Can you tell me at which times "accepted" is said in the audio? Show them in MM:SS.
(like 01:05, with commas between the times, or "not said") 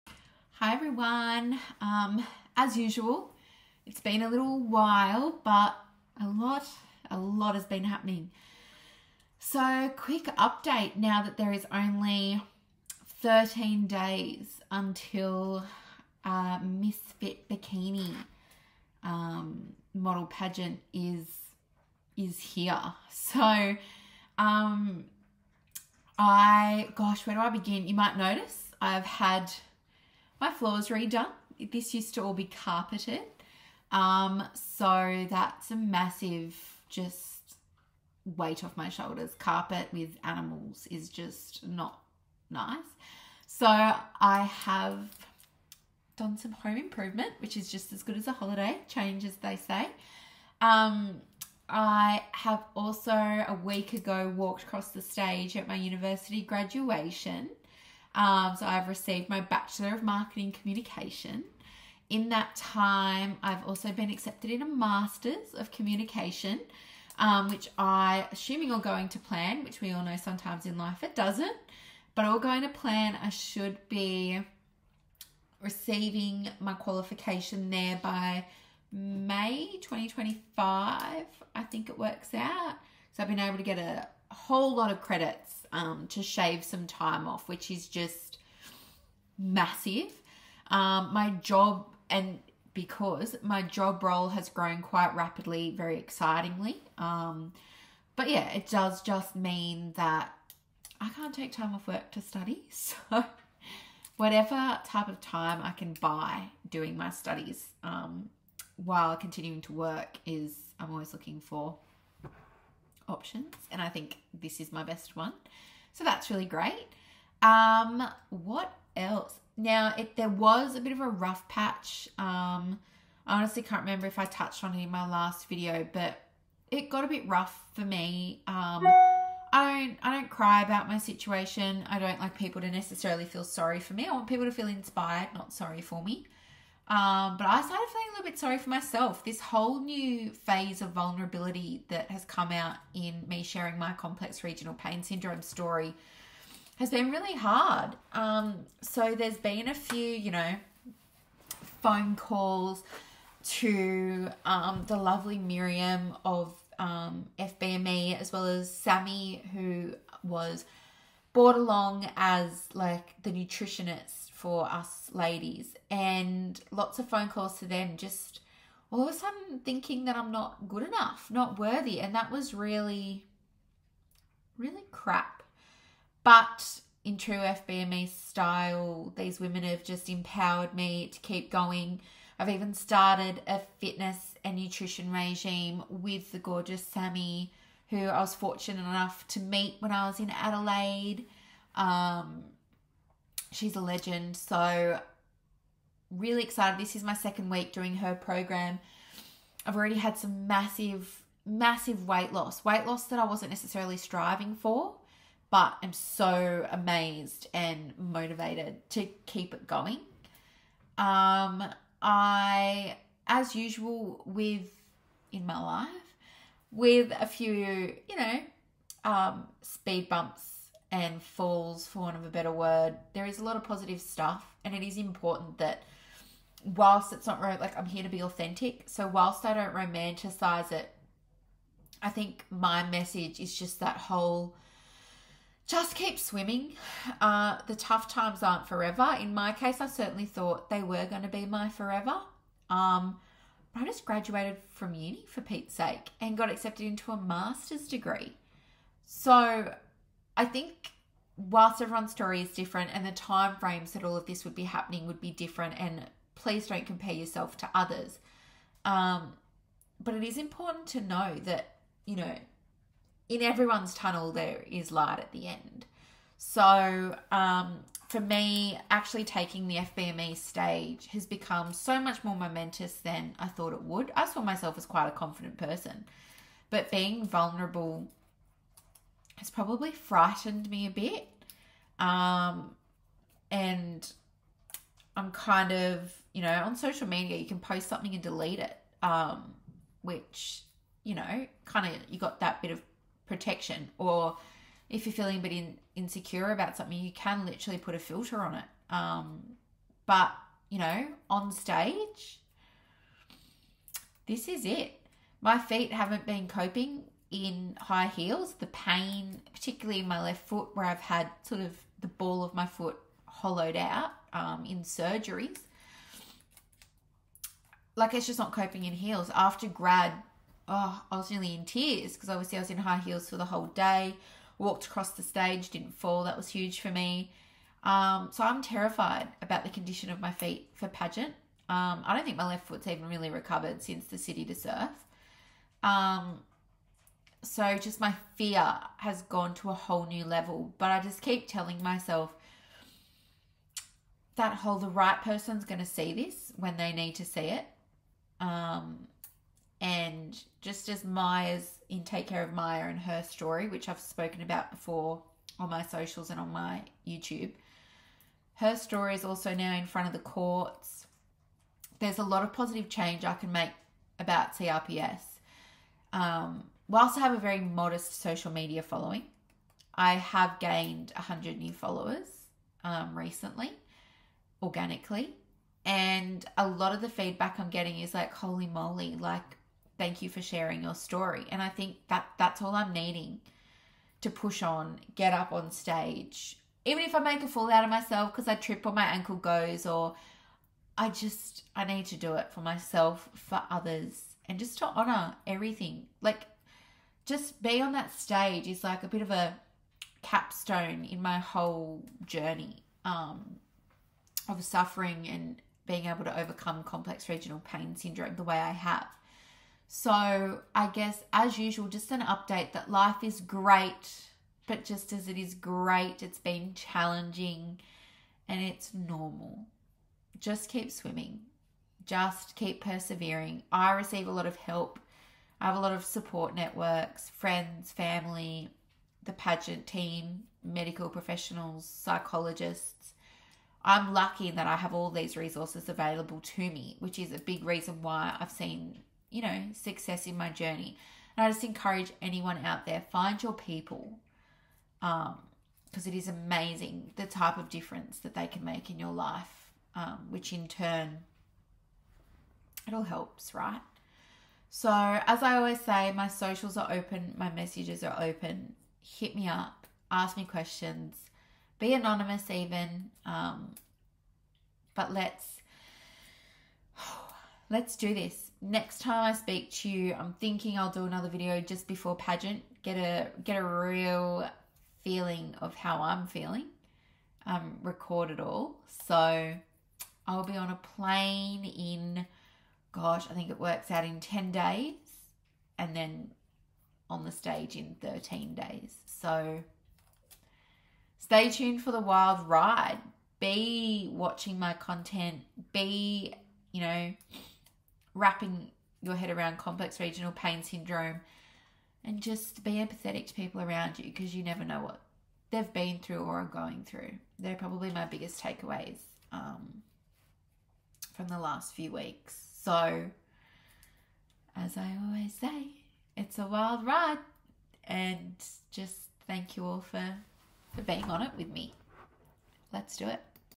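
01:04, 04:06.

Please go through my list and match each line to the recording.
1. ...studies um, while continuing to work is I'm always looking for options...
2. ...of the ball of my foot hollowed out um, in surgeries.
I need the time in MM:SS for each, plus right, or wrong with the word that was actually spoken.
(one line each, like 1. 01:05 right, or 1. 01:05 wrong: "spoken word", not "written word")
1. 01:47 right
2. 05:11 right.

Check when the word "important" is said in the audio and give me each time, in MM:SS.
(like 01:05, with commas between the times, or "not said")
03:44, 04:20.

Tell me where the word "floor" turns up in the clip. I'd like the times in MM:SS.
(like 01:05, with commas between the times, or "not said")
00:30.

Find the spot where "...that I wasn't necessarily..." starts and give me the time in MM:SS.
03:23.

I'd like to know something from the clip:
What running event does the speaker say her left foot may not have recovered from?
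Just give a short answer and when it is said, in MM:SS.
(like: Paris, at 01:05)
City to Surf, at 05:34.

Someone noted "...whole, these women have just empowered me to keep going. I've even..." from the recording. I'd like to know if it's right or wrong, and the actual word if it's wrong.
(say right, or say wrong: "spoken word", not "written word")
wrong: "style", not "whole".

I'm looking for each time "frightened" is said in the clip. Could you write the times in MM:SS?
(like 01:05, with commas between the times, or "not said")
04:39.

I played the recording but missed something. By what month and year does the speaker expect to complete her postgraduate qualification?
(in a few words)
May 2025.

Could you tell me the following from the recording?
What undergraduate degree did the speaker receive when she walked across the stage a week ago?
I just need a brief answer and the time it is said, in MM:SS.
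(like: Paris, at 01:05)
Bachelor of Marketing Communication, at 00:59.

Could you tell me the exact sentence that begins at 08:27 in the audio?
They're probably my biggest takeaways um, from the last few weeks.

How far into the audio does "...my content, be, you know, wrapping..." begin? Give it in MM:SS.
08:14.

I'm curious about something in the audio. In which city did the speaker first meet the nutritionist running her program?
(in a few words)
Adelaide.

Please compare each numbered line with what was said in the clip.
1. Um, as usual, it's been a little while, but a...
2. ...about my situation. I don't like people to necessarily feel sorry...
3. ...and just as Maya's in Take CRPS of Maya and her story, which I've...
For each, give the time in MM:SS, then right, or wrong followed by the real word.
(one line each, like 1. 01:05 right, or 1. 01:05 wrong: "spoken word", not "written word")
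1. 00:01 right
2. 02:10 right
3. 05:49 wrong: "Care", not "CRPS".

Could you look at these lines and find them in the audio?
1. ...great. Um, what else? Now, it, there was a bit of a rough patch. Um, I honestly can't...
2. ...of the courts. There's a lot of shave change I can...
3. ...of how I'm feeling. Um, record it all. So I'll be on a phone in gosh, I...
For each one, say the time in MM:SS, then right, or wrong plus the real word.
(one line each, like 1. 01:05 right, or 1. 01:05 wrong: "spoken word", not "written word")
1. 01:56 right
2. 06:00 wrong: "positive", not "shave"
3. 07:55 wrong: "plane", not "phone".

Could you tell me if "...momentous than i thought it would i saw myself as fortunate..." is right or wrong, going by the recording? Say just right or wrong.
wrong.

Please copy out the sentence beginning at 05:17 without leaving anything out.
Like it's just not coping in heels.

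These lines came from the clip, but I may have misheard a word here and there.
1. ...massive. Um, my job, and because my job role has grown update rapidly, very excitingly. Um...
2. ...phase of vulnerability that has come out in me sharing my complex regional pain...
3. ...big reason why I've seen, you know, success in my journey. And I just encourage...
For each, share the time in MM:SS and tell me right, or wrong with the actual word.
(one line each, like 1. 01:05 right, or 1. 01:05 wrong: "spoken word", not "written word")
1. 01:29 wrong: "quite", not "update"
2. 02:20 right
3. 07:17 right.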